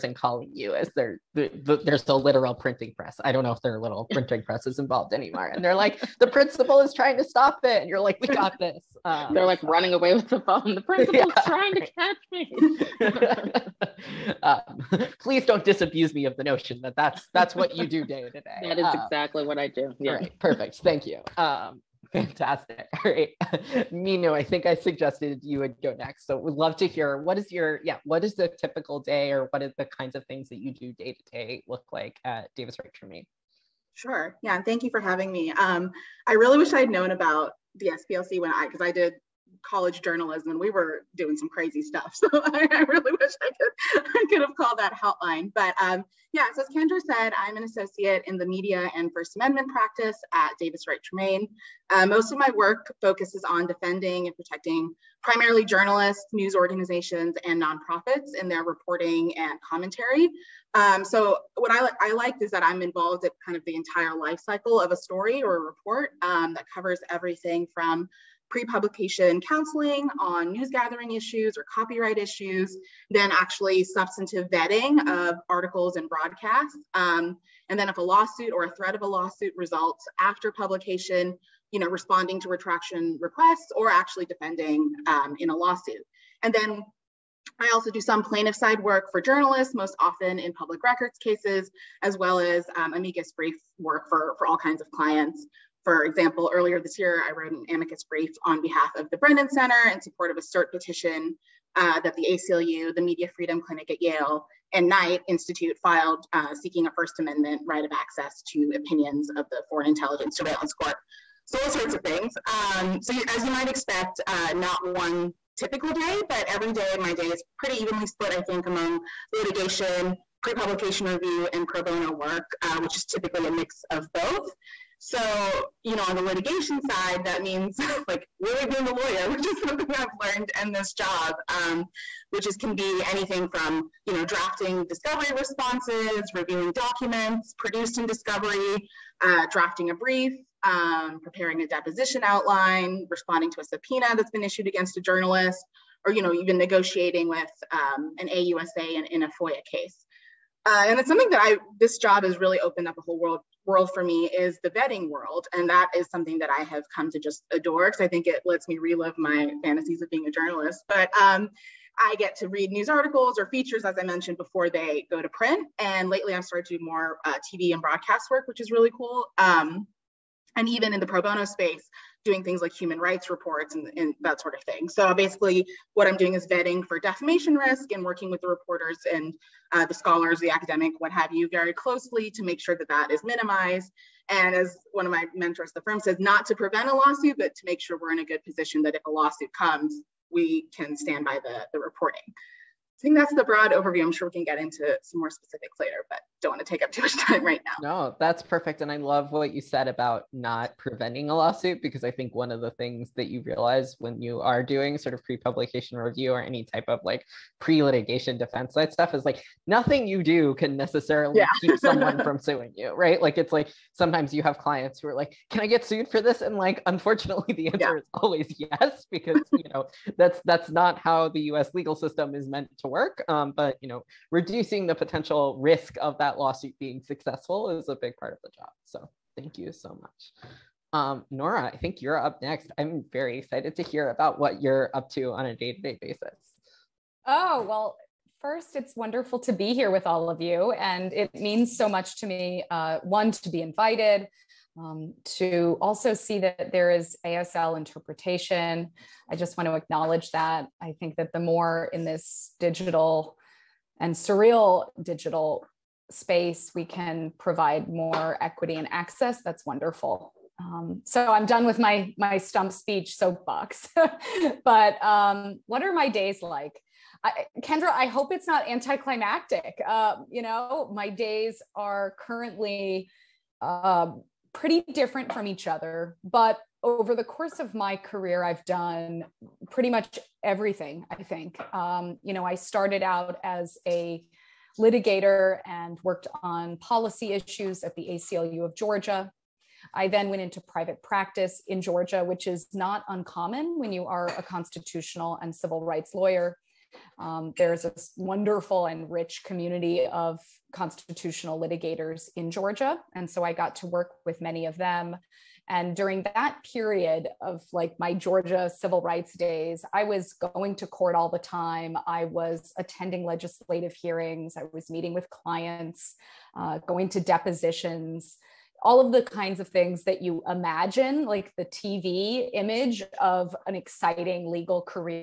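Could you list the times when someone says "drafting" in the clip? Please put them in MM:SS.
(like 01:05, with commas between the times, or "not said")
02:14, 02:19.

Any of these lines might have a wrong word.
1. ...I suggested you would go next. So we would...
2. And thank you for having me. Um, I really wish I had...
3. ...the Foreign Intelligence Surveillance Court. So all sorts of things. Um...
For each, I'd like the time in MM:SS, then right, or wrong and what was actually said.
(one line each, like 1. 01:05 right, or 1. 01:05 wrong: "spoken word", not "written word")
1. 00:24 right
2. 00:34 right
3. 01:49 right.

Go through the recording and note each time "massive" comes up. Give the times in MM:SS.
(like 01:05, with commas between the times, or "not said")
not said.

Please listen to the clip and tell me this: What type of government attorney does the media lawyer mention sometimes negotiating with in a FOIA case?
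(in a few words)
AUSA.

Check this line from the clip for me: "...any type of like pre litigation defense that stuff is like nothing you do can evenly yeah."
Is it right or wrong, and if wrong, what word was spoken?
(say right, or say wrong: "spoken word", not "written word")
wrong: "necessarily", not "evenly".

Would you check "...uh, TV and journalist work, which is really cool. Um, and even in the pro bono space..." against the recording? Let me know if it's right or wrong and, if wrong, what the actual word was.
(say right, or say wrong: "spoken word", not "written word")
wrong: "broadcast", not "journalist".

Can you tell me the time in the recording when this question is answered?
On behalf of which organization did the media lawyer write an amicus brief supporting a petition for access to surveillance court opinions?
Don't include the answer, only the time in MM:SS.
01:39.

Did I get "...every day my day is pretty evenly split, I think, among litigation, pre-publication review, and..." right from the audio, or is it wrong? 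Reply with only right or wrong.
right.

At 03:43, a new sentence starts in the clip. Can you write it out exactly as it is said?
Um, but you know, reducing the potential risk of that lawsuit being successful is a big part of the job.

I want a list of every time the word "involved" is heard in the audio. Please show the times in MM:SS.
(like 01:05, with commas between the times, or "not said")
00:04, 01:02.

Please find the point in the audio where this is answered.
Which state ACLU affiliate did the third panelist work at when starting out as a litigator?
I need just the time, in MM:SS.
04:48.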